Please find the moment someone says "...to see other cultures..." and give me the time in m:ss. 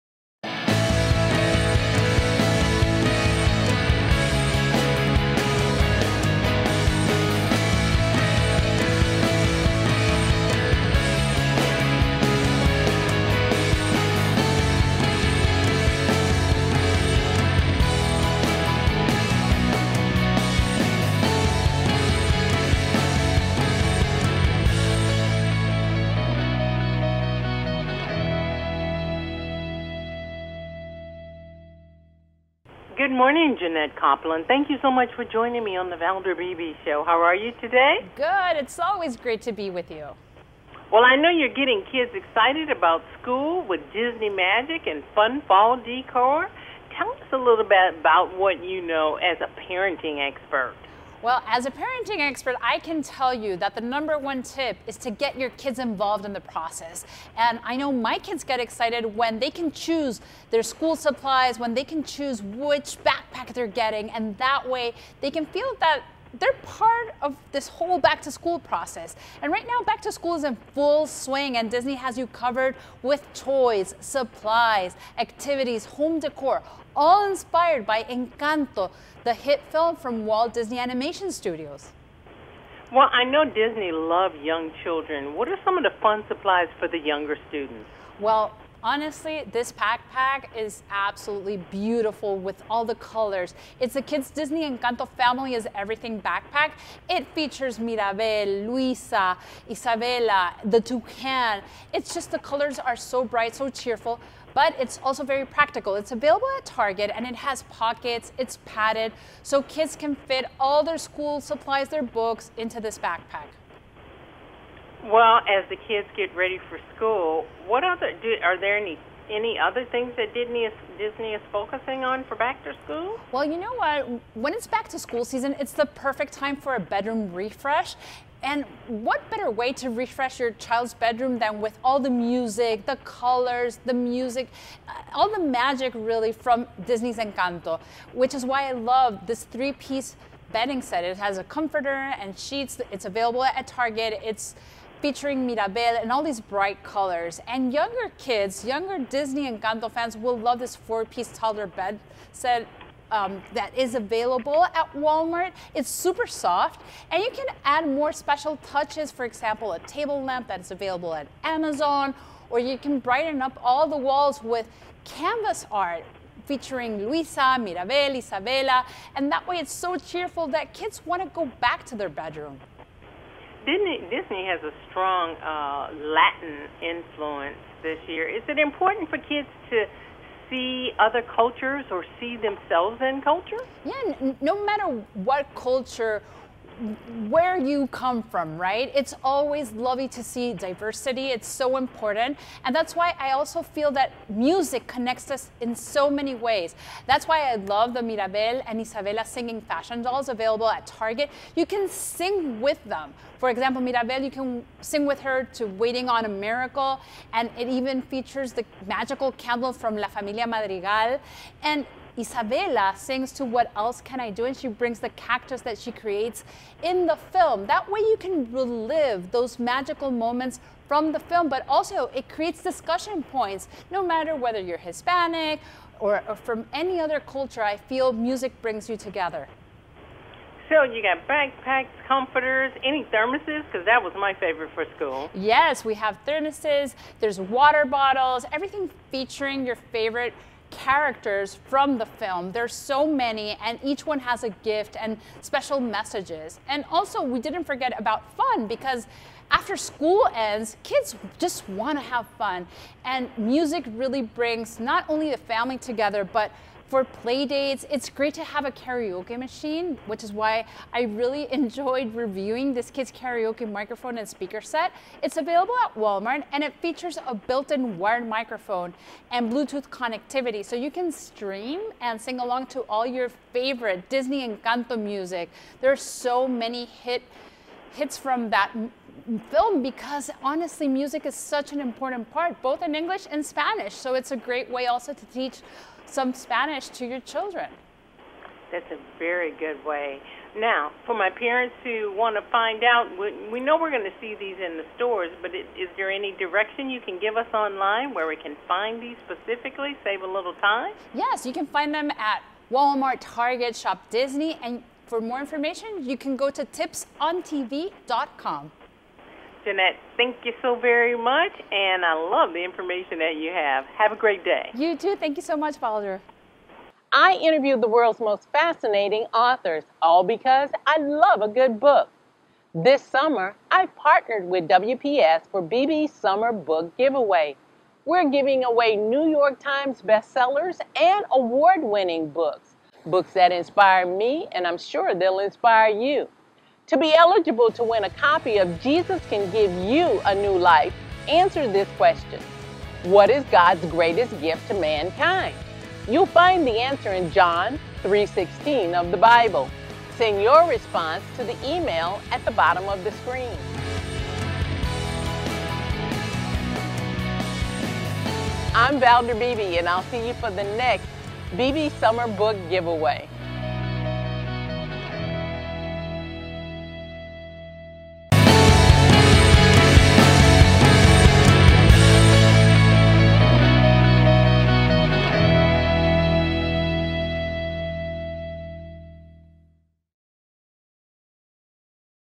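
2:59.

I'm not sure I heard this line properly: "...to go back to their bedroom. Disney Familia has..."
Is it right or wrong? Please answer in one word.
wrong.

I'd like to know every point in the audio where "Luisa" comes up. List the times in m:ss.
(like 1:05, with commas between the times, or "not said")
1:38, 2:47.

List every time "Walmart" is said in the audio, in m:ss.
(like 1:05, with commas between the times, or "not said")
2:34, 4:25, 5:02.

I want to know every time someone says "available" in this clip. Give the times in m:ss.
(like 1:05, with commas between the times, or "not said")
1:46, 2:23, 2:33, 2:40, 3:20, 4:25.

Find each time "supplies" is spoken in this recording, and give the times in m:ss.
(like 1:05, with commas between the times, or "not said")
1:00, 1:13, 1:26, 1:51.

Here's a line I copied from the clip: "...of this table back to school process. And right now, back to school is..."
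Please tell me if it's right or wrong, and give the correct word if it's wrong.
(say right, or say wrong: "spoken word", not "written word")
wrong: "whole", not "table".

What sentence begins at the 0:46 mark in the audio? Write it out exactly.
Tell us a little bit about what you know as a parenting expert.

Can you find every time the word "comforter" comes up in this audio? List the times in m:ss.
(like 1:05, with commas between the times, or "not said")
2:21, 3:52.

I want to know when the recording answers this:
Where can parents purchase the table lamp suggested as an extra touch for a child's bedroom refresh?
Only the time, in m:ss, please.
2:41.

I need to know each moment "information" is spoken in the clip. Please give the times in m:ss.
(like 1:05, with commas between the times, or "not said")
5:05, 5:12.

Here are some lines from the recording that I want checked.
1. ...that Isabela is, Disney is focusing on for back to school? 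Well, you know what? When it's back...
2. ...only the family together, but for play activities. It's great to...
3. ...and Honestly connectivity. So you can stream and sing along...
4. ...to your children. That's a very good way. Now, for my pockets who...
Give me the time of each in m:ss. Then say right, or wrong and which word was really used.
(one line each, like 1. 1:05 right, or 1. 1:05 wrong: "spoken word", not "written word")
1. 2:00 wrong: "Disney", not "Isabela"
2. 4:15 wrong: "dates", not "activities"
3. 4:29 wrong: "Bluetooth", not "Honestly"
4. 4:46 wrong: "parents", not "pockets".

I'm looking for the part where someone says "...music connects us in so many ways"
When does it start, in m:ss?
3:14.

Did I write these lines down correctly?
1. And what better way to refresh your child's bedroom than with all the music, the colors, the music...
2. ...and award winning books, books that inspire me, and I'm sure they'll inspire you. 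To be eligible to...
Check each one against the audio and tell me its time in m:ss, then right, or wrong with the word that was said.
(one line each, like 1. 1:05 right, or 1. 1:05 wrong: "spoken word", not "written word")
1. 2:08 right
2. 5:30 right.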